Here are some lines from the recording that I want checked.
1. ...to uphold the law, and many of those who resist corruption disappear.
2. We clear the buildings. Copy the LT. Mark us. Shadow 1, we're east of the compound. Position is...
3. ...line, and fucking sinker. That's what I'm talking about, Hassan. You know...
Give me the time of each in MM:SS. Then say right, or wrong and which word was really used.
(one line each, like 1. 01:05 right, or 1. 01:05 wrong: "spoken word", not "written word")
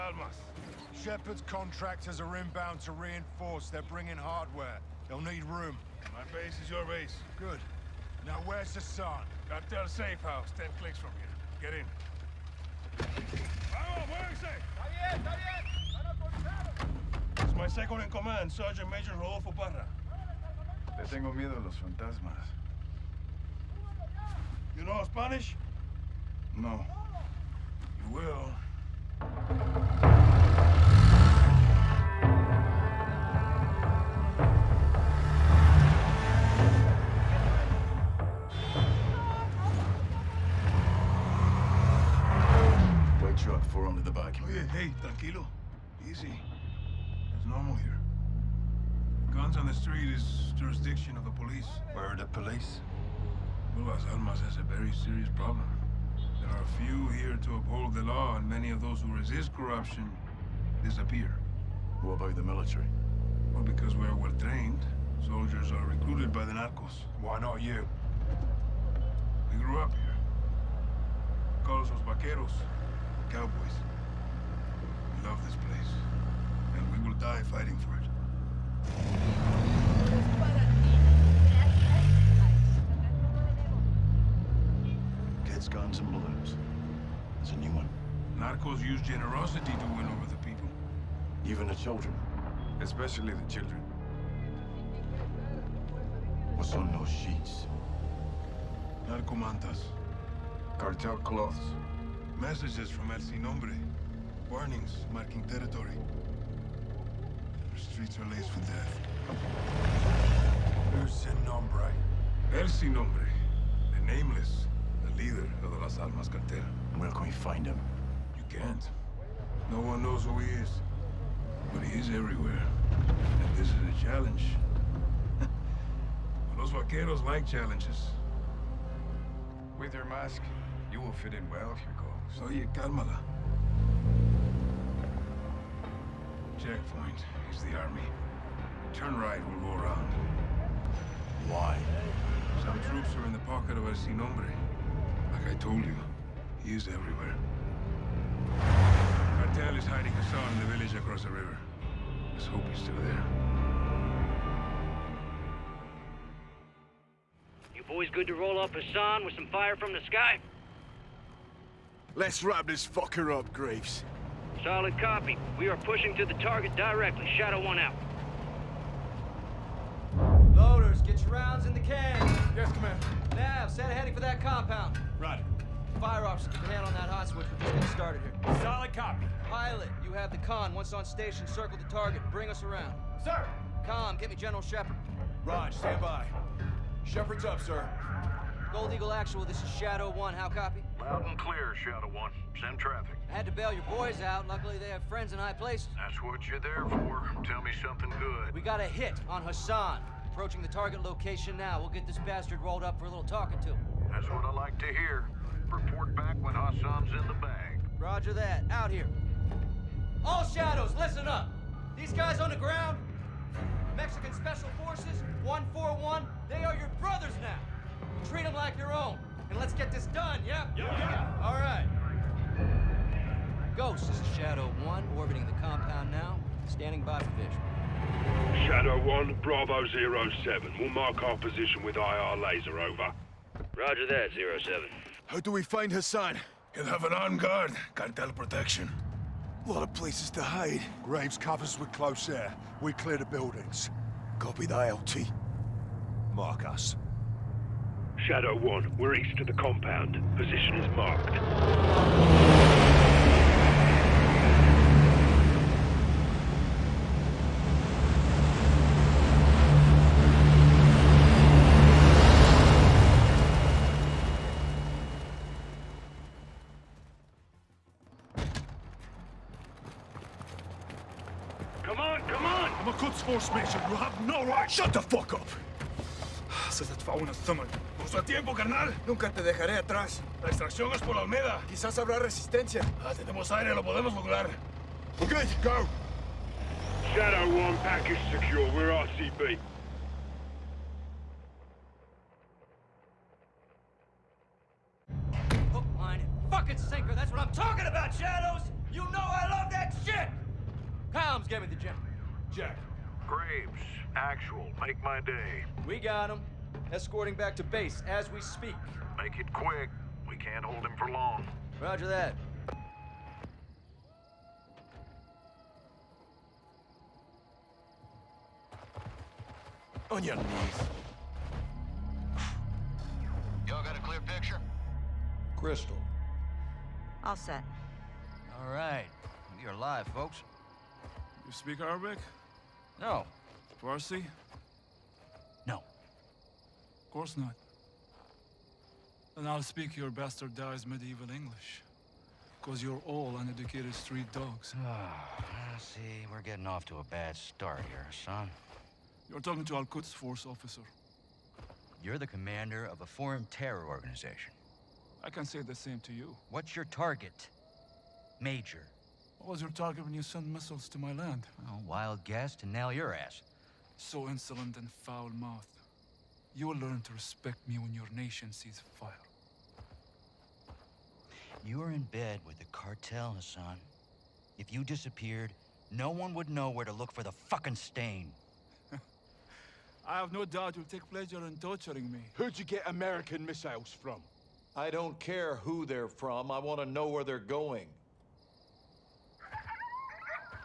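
1. 00:57 right
2. 04:02 right
3. 04:55 wrong: "Shadows", not "Hassan".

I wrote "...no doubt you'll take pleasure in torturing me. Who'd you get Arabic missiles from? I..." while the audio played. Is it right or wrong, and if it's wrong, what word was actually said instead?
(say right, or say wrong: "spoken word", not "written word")
wrong: "American", not "Arabic".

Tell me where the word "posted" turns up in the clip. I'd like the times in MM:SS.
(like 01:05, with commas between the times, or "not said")
not said.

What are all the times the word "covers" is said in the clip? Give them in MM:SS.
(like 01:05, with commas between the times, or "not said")
04:01.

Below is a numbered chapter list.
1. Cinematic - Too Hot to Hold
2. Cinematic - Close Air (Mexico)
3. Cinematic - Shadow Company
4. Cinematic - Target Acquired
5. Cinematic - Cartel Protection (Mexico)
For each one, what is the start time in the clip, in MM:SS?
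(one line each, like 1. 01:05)
1. 05:13
2. 04:28
3. 02:49
4. 04:54
5. 02:37.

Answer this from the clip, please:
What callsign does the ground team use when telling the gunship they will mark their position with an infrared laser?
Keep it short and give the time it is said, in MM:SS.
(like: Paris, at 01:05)
Bravo 07, at 03:49.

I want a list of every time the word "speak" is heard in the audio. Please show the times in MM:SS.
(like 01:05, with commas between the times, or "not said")
05:08, 05:31, 05:39.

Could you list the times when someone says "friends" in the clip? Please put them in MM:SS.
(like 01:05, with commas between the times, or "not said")
03:15.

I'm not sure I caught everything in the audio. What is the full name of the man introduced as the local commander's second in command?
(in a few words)
Rodolfo Parra.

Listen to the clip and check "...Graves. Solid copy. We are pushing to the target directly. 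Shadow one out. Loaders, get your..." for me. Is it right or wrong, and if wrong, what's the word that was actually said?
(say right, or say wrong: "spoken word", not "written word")
right.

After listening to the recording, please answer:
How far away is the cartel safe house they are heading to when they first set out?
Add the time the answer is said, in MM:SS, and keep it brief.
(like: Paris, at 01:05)
10 clicks, at 00:10.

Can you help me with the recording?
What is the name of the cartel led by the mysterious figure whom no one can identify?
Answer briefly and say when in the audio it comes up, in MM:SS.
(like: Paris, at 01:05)
Las Almas Cartel, at 01:55.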